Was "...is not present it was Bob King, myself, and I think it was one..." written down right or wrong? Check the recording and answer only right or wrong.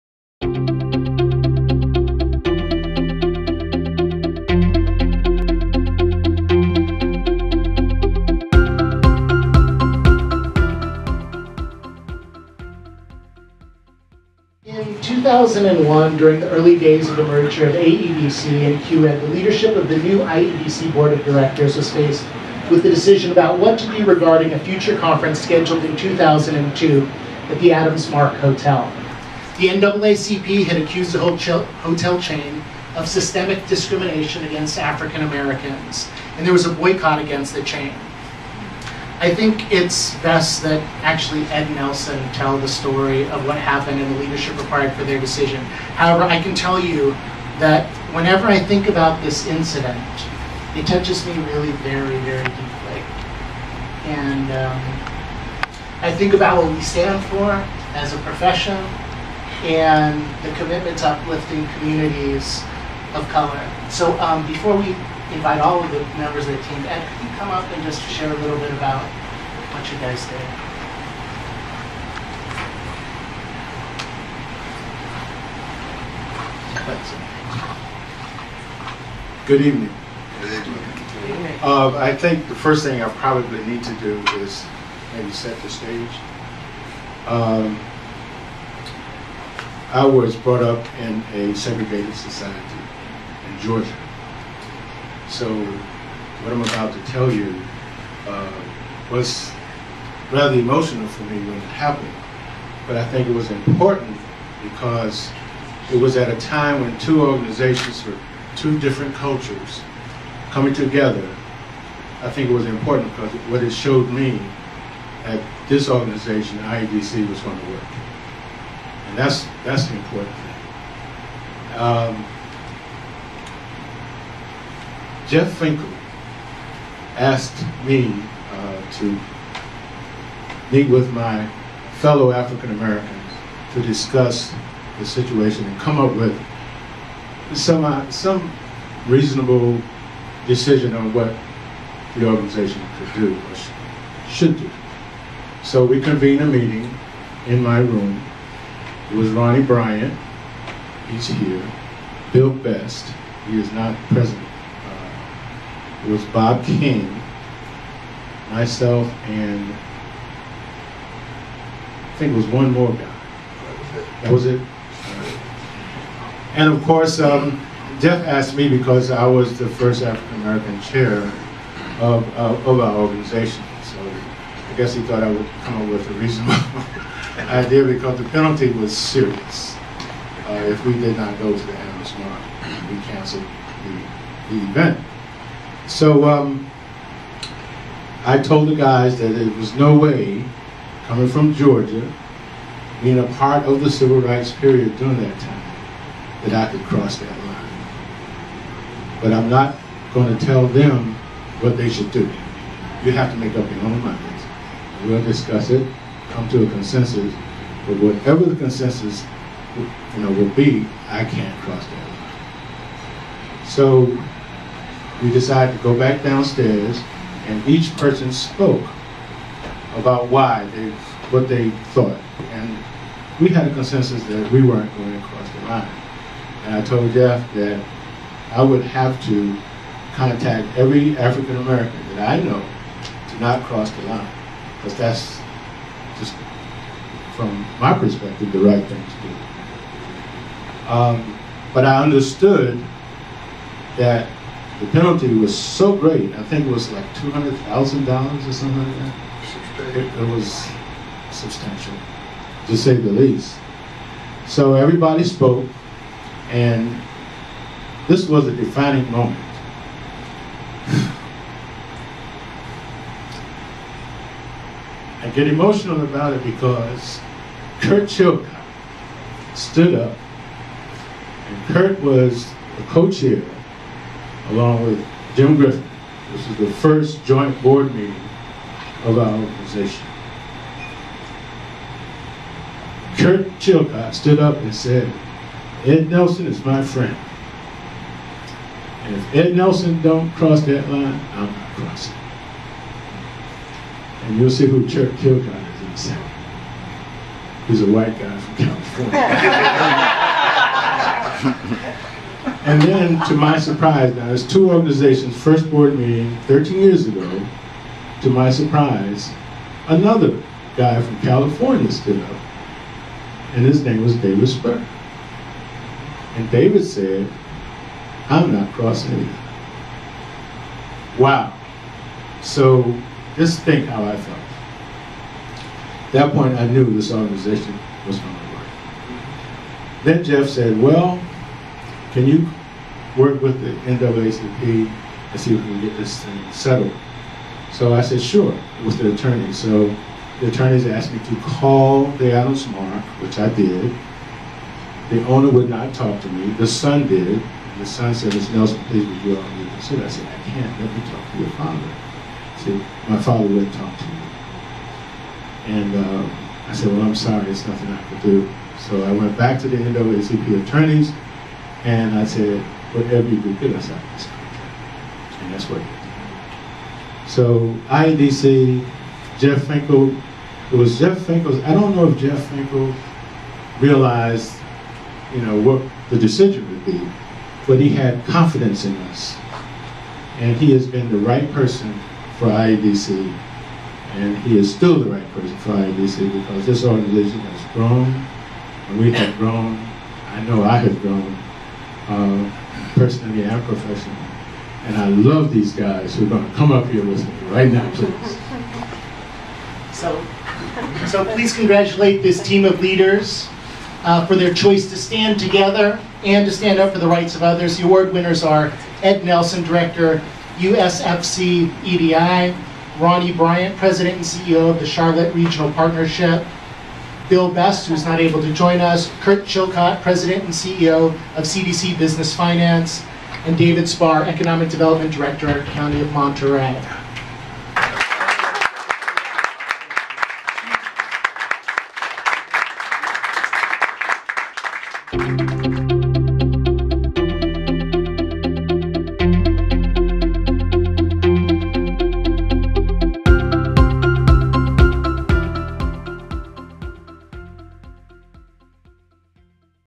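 right.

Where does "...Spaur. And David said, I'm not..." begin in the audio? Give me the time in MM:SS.
05:14.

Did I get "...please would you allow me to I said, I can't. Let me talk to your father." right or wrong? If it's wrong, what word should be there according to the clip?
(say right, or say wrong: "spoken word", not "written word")
right.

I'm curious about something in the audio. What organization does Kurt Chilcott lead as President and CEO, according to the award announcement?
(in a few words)
CDC Business Finance.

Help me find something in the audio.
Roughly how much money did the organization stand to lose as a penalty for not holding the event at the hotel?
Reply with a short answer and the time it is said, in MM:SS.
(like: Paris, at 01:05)
$200,000, at 04:07.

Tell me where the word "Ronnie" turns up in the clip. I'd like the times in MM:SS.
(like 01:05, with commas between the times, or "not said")
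02:29, 06:52.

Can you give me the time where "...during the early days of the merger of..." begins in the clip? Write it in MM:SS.
00:16.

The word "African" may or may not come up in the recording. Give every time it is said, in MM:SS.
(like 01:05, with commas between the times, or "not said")
00:34, 02:12, 02:50, 03:51.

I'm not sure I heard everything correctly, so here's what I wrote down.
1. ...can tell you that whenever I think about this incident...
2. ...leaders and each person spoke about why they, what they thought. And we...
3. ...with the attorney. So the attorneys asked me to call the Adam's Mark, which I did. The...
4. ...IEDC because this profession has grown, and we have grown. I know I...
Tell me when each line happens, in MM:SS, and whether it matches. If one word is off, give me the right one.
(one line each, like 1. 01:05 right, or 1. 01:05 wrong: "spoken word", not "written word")
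1. 00:46 right
2. 03:36 wrong: "downstairs", not "leaders"
3. 05:38 right
4. 06:25 wrong: "organization", not "profession".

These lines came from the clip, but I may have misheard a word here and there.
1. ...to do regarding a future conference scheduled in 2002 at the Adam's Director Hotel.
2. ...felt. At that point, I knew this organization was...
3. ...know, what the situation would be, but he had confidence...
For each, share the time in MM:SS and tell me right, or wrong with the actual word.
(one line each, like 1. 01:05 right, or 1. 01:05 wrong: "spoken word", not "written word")
1. 00:23 wrong: "Mark", not "Director"
2. 05:24 right
3. 06:15 wrong: "decision", not "situation".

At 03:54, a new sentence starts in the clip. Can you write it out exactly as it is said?
Because that's just, from my perspective, the right thing to do.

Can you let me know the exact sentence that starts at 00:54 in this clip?
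And um, I think about what we stand for as a profession and the commitment to uplifting communities of color.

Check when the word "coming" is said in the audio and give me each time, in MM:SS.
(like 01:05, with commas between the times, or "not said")
01:50, 03:11.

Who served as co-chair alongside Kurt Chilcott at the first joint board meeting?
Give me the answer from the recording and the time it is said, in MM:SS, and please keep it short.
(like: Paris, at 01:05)
Jim Griffin, at 04:35.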